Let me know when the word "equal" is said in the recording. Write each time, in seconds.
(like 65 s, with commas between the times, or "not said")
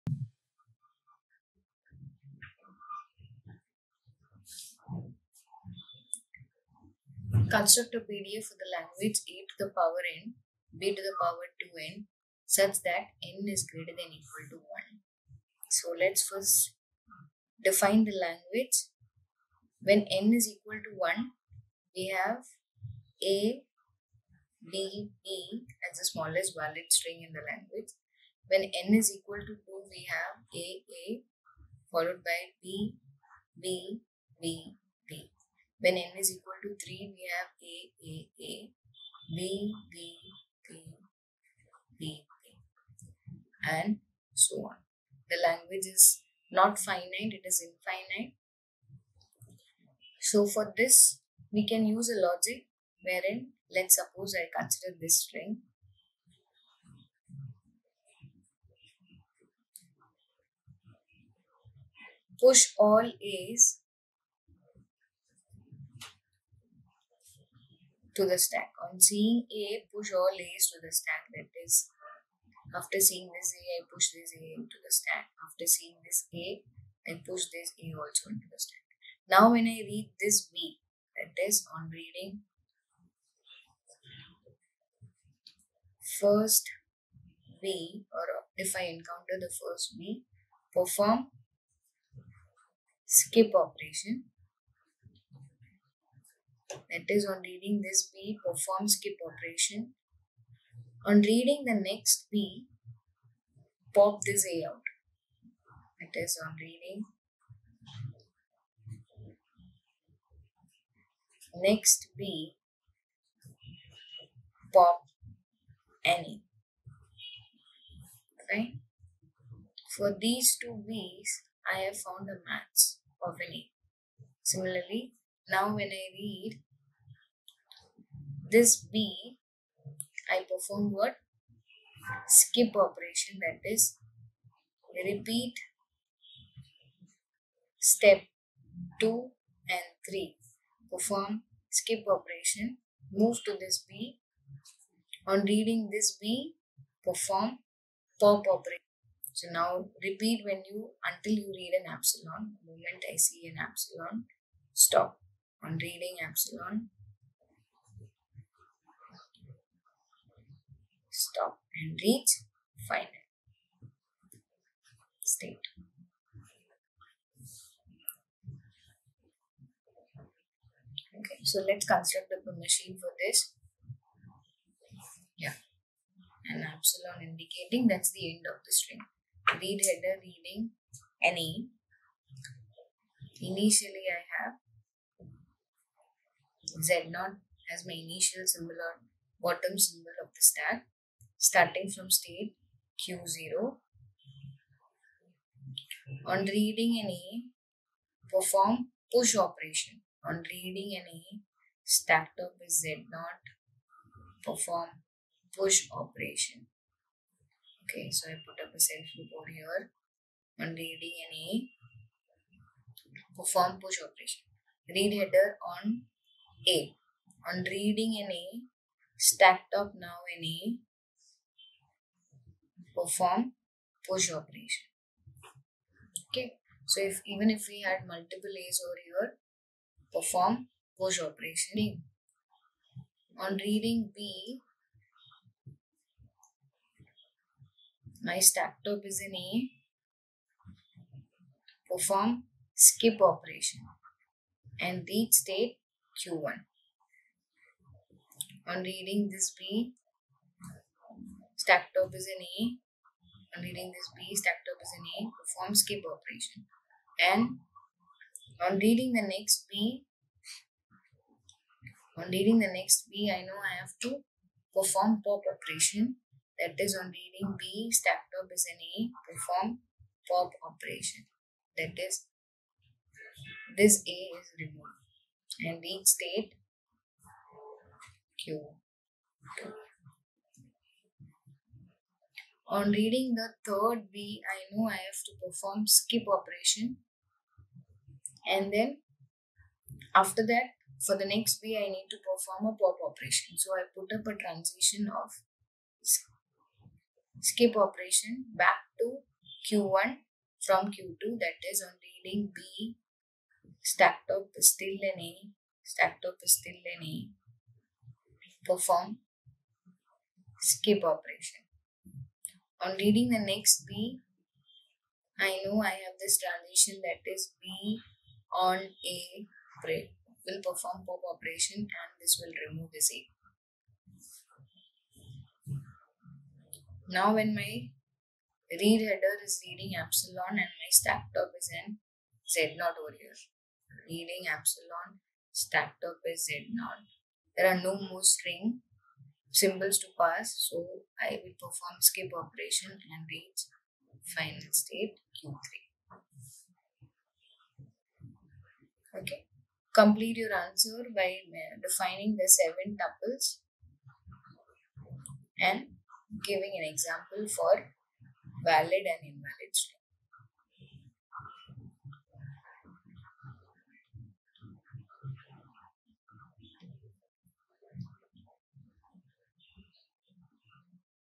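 14 s, 20 s, 29 s, 36 s.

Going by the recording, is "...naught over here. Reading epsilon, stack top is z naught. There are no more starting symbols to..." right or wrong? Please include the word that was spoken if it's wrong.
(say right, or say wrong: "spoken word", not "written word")
wrong: "string", not "starting".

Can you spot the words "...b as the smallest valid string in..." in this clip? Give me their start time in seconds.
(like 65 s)
25 s.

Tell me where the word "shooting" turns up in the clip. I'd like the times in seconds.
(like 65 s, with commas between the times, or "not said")
not said.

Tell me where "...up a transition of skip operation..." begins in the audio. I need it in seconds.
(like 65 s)
294 s.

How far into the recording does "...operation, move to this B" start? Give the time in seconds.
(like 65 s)
142 s.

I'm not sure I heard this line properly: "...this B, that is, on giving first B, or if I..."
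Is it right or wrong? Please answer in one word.
wrong.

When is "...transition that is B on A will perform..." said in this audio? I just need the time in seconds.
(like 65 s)
316 s.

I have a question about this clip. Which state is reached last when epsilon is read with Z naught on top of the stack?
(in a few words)
Q3.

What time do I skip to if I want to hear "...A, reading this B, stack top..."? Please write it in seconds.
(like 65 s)
252 s.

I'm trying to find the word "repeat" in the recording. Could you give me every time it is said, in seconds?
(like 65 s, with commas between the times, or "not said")
135 s, 150 s.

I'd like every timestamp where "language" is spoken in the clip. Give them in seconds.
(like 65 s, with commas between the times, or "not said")
8 s, 18 s, 27 s, 45 s.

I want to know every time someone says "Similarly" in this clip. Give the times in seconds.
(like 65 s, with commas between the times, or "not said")
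124 s.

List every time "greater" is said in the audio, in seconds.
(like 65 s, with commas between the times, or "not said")
13 s.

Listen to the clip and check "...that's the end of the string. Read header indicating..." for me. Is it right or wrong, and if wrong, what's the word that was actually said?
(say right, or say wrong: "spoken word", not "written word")
wrong: "reading", not "indicating".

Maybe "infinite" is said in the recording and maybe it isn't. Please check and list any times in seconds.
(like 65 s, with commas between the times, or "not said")
47 s.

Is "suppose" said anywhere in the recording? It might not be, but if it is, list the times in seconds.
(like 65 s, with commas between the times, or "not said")
53 s.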